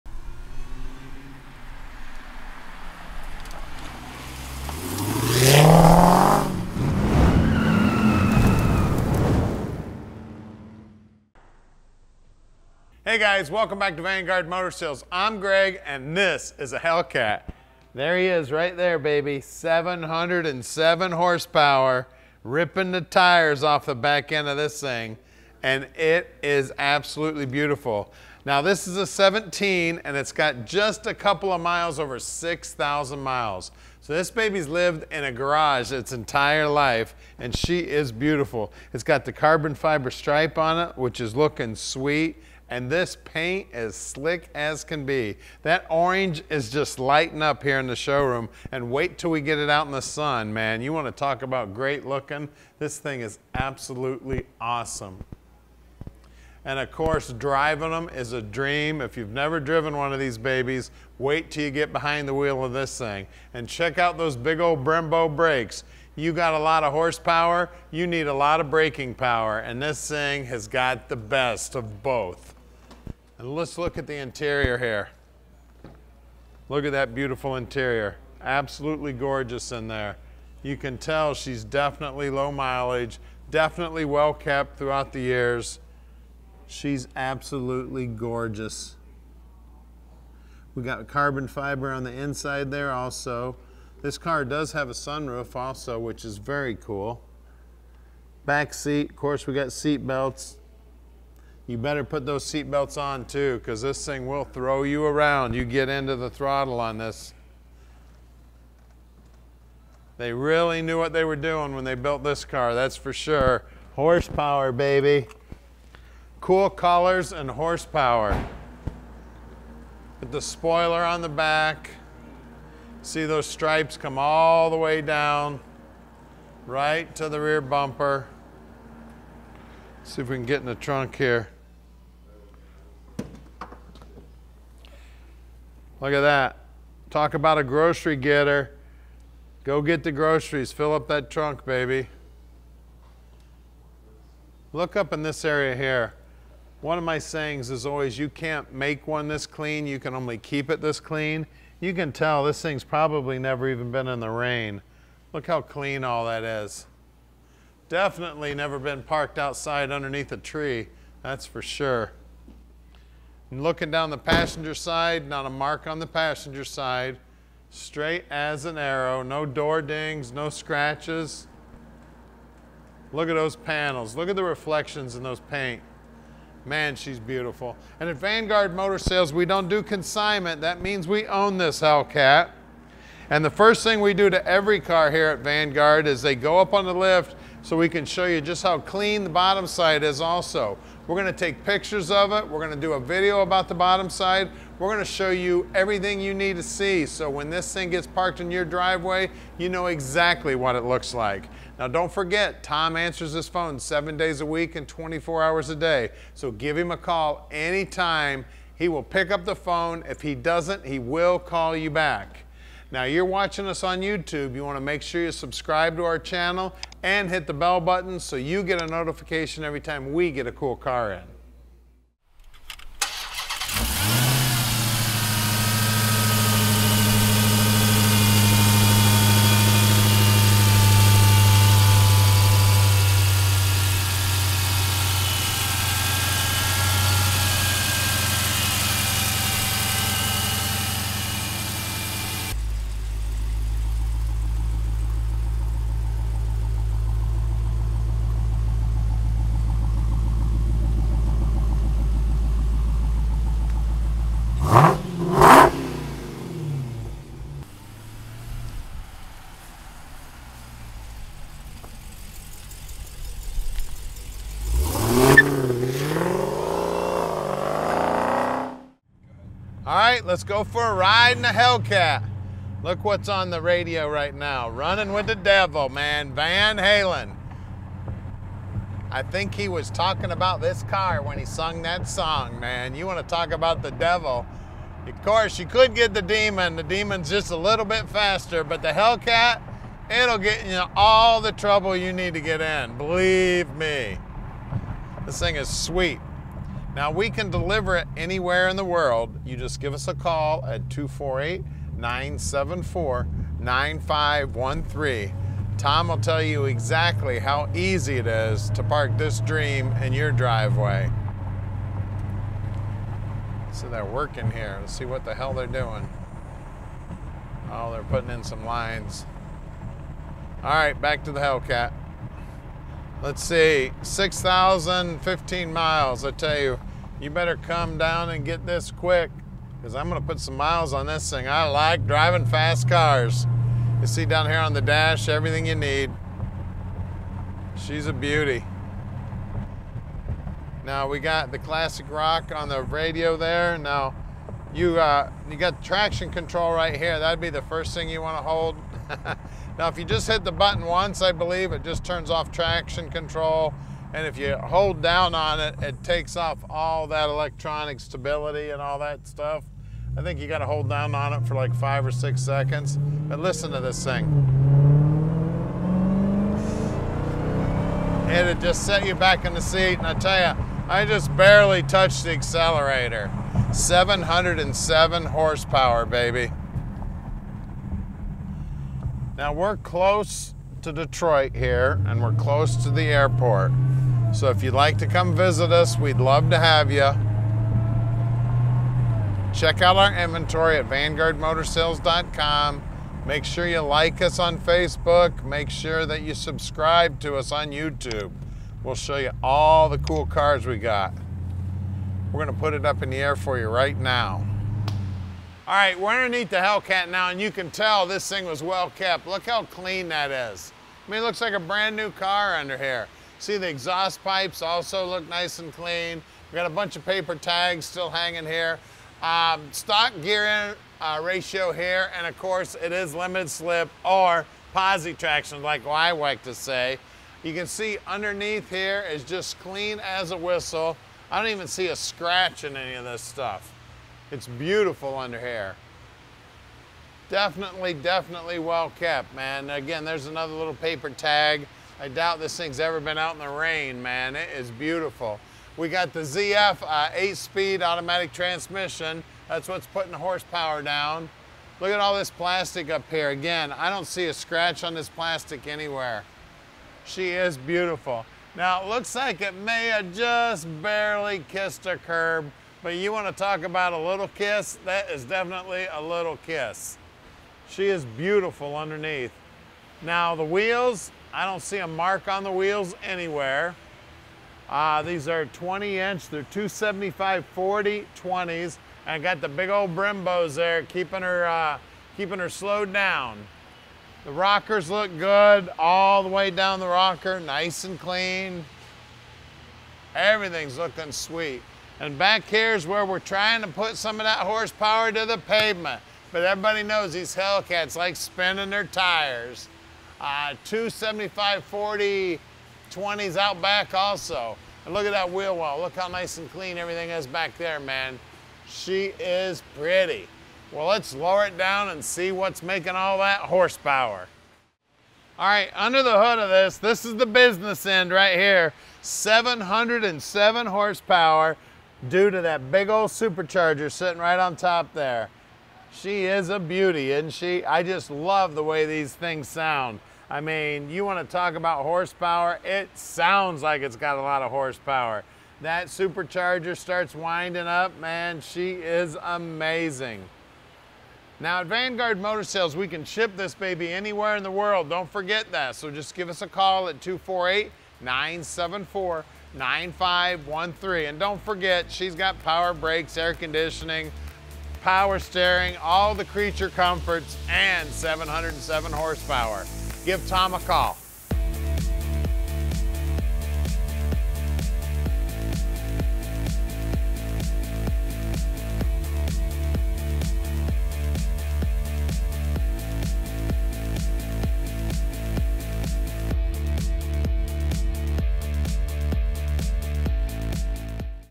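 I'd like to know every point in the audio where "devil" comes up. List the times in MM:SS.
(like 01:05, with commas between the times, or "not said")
04:35, 04:43.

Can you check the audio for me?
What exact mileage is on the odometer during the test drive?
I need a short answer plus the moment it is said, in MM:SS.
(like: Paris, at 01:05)
6,015 miles, at 05:24.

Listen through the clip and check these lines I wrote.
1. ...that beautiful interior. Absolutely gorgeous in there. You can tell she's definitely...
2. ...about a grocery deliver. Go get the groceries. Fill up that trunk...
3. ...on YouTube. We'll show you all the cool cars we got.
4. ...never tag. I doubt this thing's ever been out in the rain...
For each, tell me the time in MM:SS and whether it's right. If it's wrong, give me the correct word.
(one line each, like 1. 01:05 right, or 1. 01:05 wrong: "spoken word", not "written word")
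1. 01:16 right
2. 02:17 wrong: "getter", not "deliver"
3. 06:37 right
4. 07:20 wrong: "paper", not "never".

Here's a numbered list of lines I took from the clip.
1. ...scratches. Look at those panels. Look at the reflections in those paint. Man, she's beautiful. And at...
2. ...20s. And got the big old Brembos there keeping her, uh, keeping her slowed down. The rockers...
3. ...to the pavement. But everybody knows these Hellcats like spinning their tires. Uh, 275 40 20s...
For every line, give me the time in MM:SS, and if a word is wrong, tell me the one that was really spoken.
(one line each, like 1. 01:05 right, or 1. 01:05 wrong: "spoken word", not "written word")
1. 02:50 right
2. 07:58 right
3. 08:15 right.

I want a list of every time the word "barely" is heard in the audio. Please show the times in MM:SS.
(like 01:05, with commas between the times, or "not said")
06:11, 07:40.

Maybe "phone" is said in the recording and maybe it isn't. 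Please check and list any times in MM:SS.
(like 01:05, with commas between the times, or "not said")
03:23, 03:29.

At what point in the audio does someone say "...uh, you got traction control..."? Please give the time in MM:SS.
05:44.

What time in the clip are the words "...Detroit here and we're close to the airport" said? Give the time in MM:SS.
06:20.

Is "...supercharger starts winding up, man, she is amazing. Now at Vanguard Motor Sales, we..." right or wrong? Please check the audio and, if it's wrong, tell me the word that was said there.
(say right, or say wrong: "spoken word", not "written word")
right.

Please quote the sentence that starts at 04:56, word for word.
Now we can deliver it anywhere in the world.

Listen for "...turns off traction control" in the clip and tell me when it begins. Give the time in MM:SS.
05:52.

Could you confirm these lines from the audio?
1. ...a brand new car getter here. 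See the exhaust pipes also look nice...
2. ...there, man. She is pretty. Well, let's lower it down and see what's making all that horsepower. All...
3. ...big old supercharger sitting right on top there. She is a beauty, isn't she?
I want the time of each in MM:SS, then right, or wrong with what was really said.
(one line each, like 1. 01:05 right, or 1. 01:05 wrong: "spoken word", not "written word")
1. 06:51 wrong: "under", not "getter"
2. 08:27 right
3. 08:42 right.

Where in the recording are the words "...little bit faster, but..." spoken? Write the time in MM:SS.
04:47.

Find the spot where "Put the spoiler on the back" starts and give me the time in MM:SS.
02:00.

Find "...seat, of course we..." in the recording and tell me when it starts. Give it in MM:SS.
01:38.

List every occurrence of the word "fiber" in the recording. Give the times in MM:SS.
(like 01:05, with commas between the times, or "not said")
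00:39, 01:31.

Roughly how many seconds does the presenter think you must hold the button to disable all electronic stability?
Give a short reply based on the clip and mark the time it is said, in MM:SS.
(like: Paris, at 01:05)
5 or 6 seconds, at 06:01.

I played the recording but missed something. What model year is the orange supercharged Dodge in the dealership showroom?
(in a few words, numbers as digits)
2017.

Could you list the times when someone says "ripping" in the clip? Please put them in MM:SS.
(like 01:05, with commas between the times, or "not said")
00:22.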